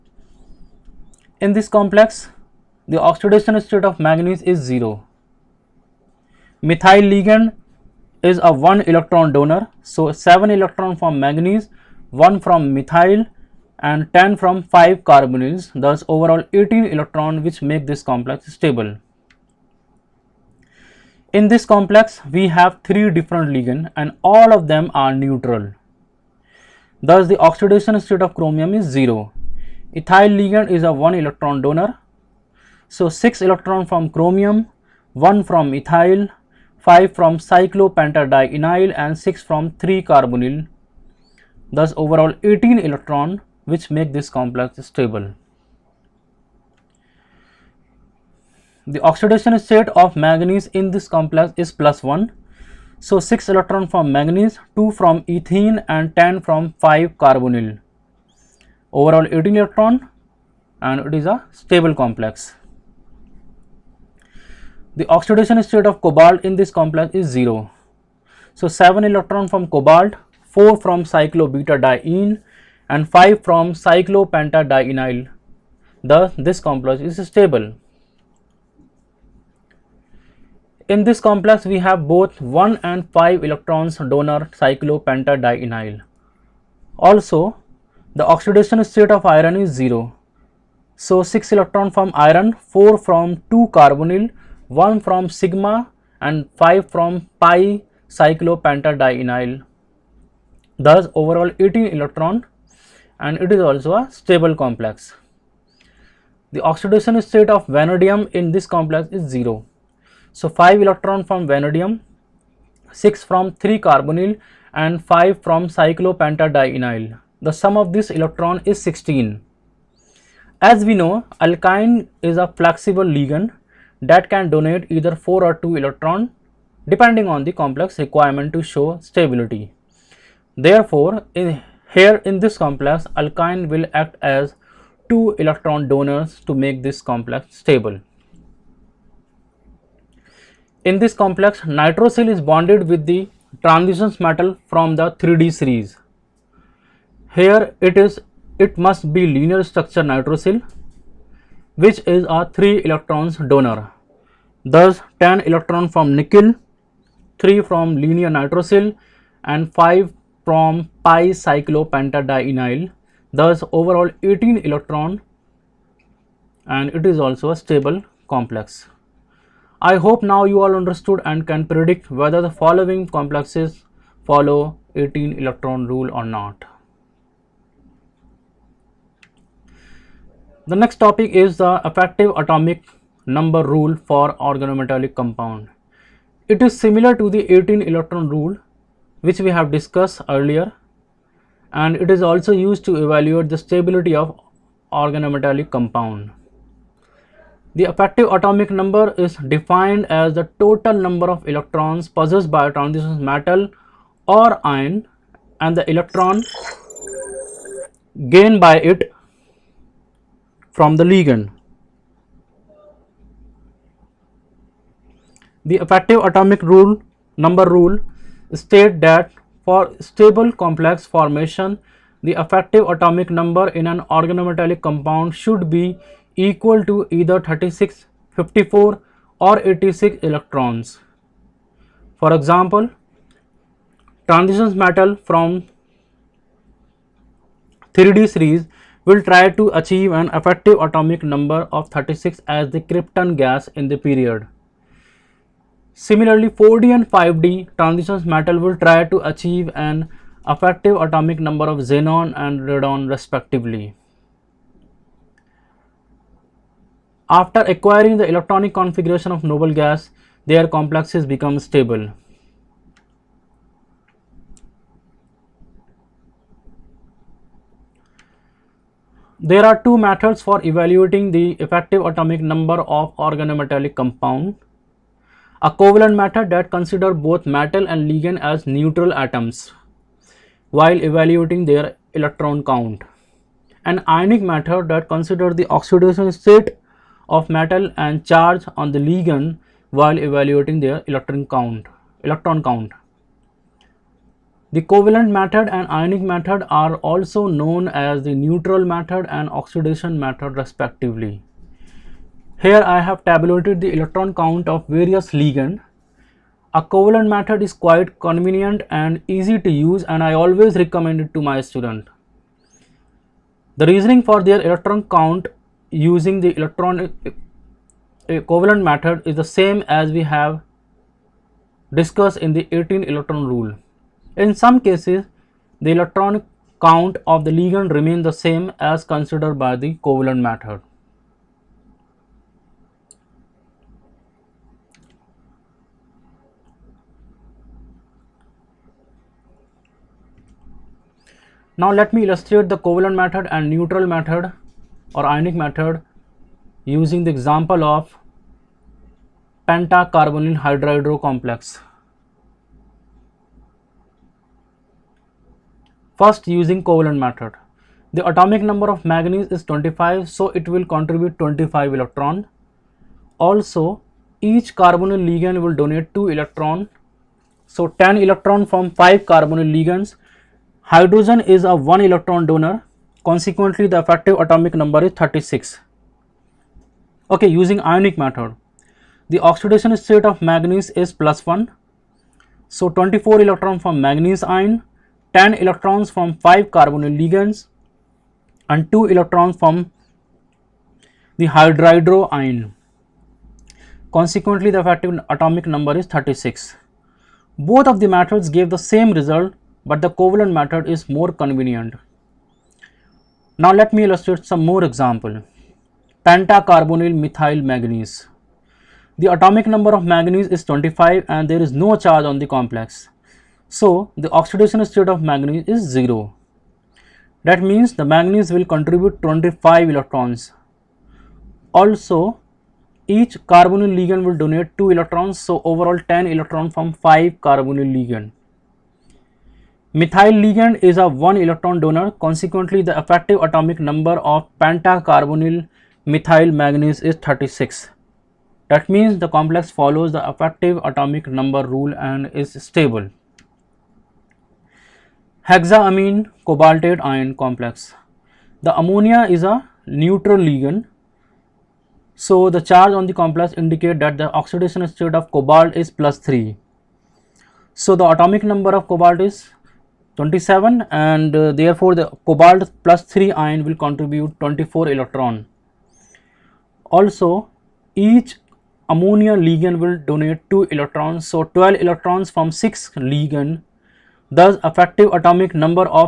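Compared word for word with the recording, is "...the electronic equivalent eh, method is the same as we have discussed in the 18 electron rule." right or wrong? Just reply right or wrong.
right.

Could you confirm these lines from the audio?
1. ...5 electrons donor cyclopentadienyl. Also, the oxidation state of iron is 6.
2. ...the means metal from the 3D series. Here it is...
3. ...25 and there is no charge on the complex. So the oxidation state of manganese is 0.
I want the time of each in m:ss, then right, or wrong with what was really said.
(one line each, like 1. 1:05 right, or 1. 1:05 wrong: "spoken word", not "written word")
1. 1:23 wrong: "0", not "6"
2. 2:23 wrong: "transitions", not "means"
3. 6:50 right.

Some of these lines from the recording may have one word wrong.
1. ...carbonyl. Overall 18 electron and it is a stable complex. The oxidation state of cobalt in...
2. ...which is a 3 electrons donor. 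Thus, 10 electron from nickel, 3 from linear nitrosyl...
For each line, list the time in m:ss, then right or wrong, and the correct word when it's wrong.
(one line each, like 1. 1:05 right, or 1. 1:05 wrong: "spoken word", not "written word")
1. 0:57 right
2. 2:31 right.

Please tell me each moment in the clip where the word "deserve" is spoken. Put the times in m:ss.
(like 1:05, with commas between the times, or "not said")
not said.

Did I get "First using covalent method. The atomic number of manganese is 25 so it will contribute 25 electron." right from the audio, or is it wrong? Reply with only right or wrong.
right.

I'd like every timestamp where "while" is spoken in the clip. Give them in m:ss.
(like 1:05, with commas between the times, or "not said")
4:40, 4:49.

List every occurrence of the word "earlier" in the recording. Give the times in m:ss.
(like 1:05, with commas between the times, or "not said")
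3:10.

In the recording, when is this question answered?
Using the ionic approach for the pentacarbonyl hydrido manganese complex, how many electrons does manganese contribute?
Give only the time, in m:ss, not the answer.
6:22.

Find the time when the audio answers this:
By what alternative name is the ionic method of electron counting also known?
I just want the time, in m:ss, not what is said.
4:59.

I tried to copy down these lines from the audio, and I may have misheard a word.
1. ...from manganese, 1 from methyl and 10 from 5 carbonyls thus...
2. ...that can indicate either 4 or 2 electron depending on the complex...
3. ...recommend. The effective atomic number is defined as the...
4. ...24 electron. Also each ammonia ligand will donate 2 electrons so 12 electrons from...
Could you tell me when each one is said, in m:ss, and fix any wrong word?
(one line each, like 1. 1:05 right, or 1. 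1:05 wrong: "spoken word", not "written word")
1. 0:10 right
2. 2:04 wrong: "donate", not "indicate"
3. 3:15 wrong: "compound", not "recommend"
4. 7:44 right.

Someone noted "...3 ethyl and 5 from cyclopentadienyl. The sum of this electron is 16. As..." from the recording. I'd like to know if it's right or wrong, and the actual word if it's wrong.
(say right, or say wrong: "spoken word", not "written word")
wrong: "carbonyl", not "ethyl".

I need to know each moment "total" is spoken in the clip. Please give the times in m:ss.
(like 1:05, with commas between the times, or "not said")
3:20.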